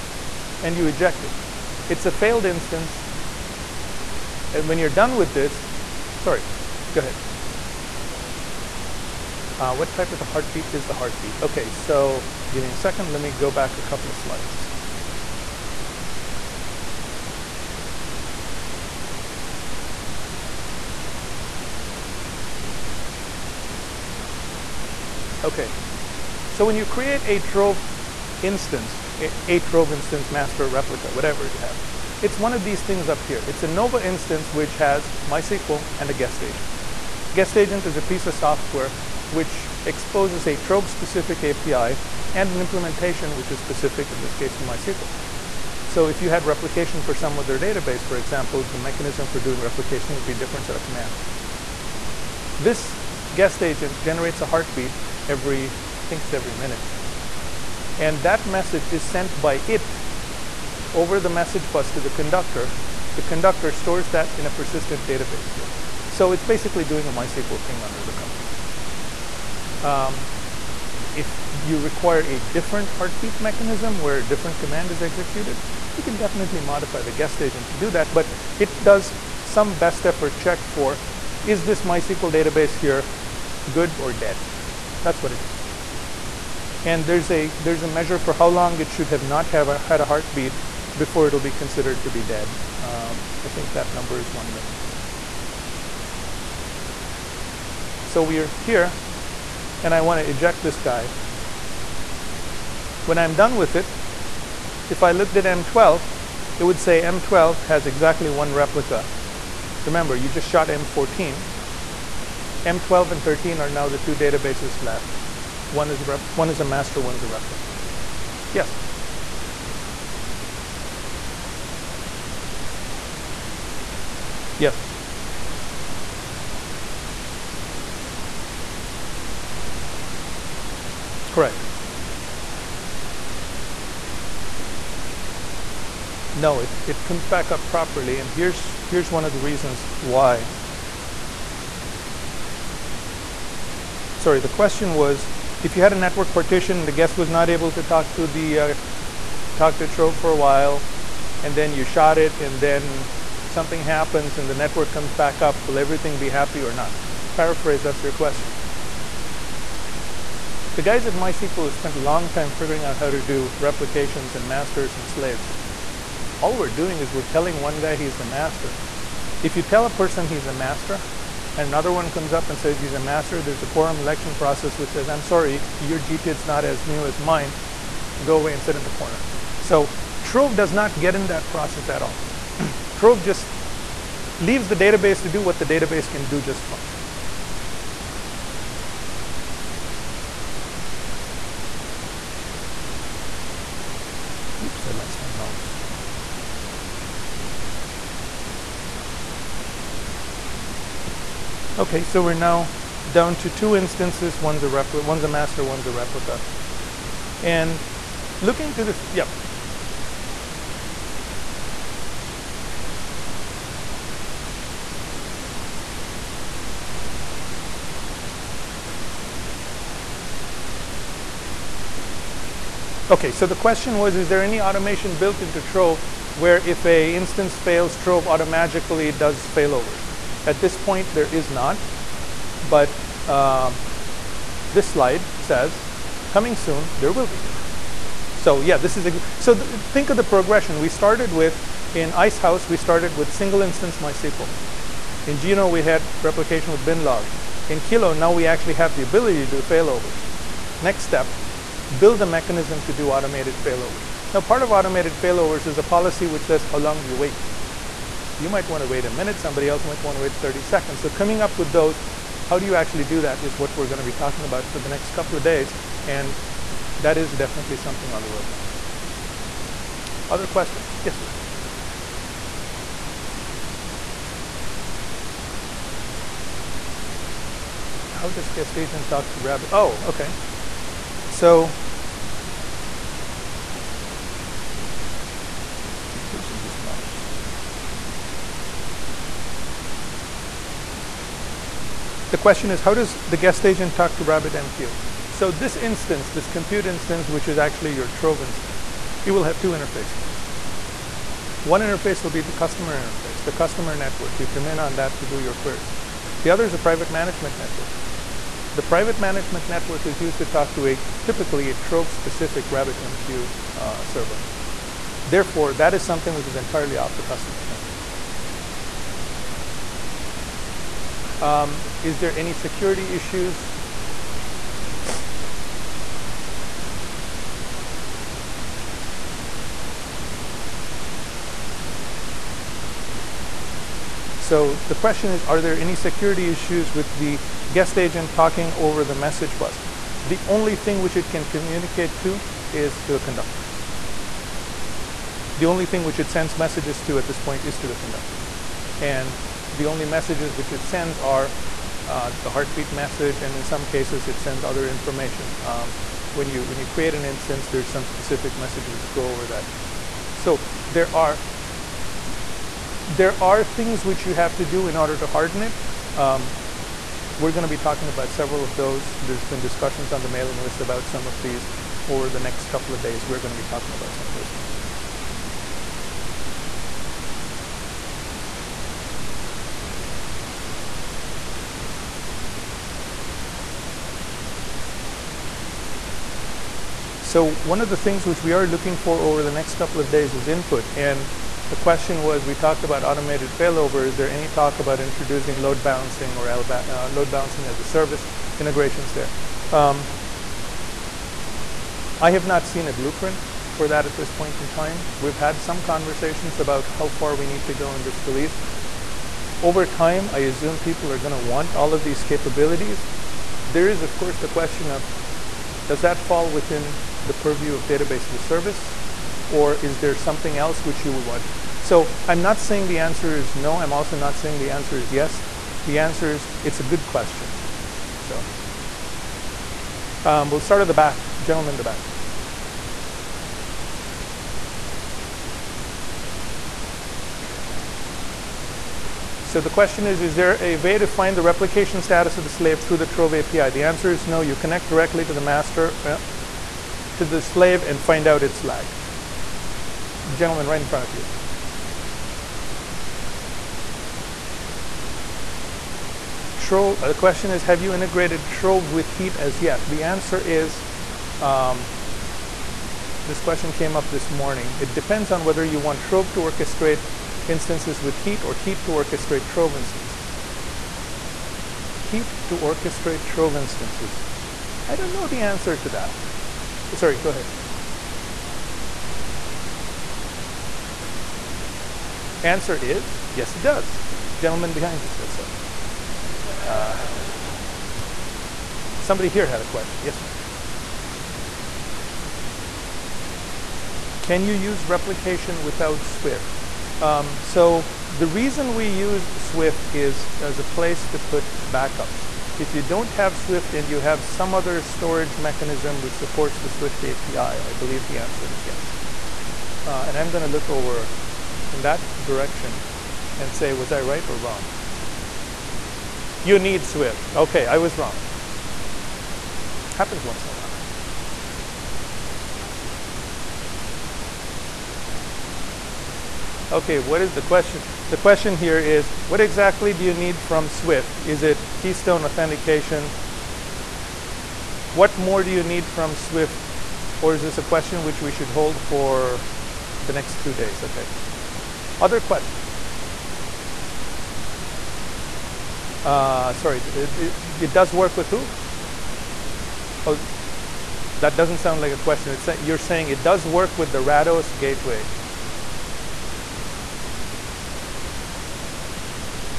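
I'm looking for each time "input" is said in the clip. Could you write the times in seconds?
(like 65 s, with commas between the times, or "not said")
390 s.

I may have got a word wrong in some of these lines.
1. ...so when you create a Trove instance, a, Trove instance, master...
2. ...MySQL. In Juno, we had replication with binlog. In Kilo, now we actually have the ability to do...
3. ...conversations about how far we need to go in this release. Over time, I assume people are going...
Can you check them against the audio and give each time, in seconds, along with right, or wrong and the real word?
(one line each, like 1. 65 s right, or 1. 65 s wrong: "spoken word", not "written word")
1. 26 s right
2. 243 s right
3. 405 s right.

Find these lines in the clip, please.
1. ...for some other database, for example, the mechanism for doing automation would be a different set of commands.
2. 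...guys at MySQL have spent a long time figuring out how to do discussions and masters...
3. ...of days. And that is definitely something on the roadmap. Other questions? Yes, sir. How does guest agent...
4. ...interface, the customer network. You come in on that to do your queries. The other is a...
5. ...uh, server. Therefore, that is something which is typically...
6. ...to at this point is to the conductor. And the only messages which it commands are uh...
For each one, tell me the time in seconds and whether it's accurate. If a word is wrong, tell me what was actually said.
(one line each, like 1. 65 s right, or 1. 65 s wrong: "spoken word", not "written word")
1. 47 s wrong: "replication", not "automation"
2. 160 s wrong: "replications", not "discussions"
3. 265 s right
4. 302 s right
5. 313 s wrong: "entirely", not "typically"
6. 347 s wrong: "sends", not "commands".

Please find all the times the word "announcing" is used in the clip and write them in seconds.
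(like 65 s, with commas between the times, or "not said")
not said.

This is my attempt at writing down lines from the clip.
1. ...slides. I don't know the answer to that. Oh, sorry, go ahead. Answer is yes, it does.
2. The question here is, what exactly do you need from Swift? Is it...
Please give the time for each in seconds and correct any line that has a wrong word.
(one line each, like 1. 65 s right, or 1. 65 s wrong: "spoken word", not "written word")
1. 473 s wrong: "instances", not "slides"
2. 528 s right.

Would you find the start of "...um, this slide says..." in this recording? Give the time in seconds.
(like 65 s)
233 s.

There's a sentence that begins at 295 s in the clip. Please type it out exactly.
So this instance, this compute instance, which is actually your Trove instance, you will have two interfaces.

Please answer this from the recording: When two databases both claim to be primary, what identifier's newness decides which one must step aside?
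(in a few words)
GTID.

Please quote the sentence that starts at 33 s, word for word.
It's a Nova instance which has MySQL and a guest agent.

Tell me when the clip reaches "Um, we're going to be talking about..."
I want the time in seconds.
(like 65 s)
366 s.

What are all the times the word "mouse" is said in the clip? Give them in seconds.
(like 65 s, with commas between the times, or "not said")
195 s, 286 s.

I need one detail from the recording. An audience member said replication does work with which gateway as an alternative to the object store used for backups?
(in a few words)
Rados gateway.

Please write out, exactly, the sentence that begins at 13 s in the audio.
Let me go back a couple of slides.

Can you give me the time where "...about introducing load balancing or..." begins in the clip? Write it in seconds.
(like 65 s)
394 s.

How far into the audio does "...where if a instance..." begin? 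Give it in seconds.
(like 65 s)
226 s.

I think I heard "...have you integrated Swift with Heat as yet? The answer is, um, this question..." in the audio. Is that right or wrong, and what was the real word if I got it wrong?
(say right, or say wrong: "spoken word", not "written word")
wrong: "Trove", not "Swift".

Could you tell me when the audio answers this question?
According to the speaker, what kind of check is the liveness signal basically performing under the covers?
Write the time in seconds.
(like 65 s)
67 s.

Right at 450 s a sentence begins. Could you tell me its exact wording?
The gentleman right in front of you.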